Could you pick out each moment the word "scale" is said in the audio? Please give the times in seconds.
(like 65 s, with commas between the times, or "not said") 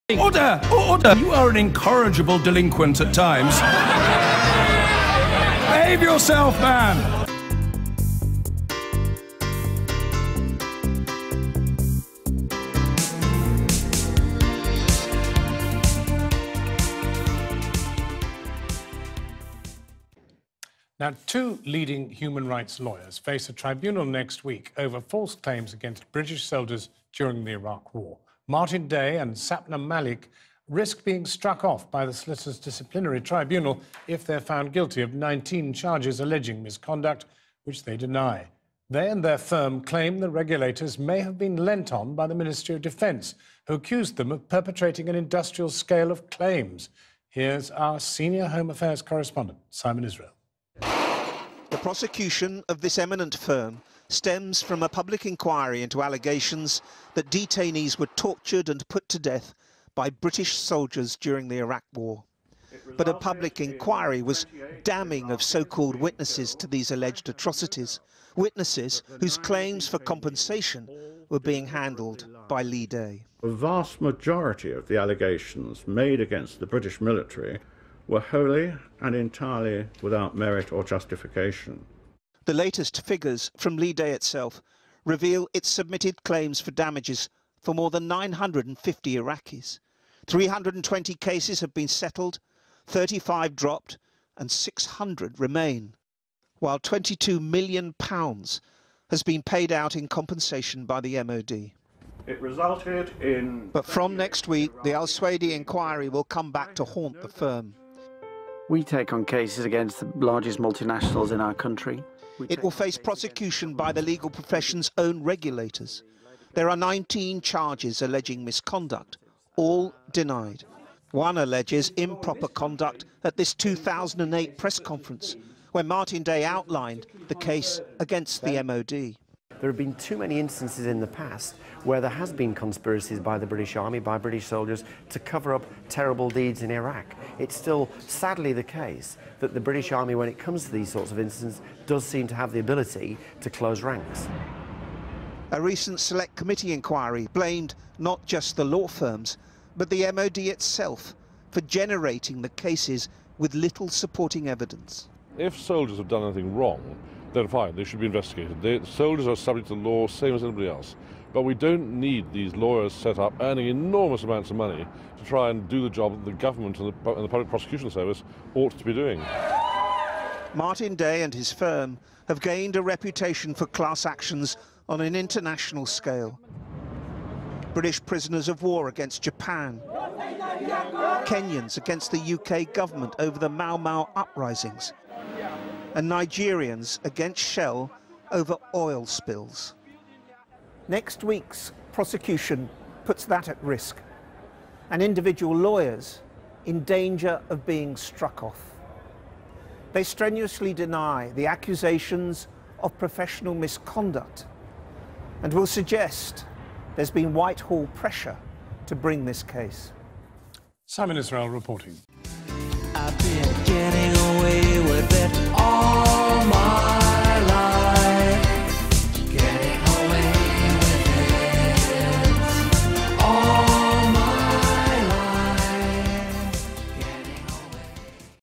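45 s, 175 s.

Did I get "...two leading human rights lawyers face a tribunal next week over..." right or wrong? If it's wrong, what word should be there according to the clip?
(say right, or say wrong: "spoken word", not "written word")
right.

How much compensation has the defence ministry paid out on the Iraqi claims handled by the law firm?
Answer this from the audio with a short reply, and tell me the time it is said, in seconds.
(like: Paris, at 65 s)
£22 million, at 96 s.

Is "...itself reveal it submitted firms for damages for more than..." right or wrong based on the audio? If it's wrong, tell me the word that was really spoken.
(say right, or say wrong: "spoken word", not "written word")
wrong: "claims", not "firms".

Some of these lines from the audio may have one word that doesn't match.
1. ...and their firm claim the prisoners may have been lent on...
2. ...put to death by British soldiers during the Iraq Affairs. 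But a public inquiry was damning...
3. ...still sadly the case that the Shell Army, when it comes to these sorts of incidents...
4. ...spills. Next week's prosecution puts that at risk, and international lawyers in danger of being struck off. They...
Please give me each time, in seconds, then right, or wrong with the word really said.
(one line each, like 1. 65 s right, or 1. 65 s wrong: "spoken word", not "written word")
1. 39 s wrong: "regulators", not "prisoners"
2. 58 s wrong: "War", not "Affairs"
3. 137 s wrong: "British", not "Shell"
4. 189 s wrong: "individual", not "international".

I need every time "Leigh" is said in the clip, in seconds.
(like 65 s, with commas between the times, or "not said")
72 s, 83 s.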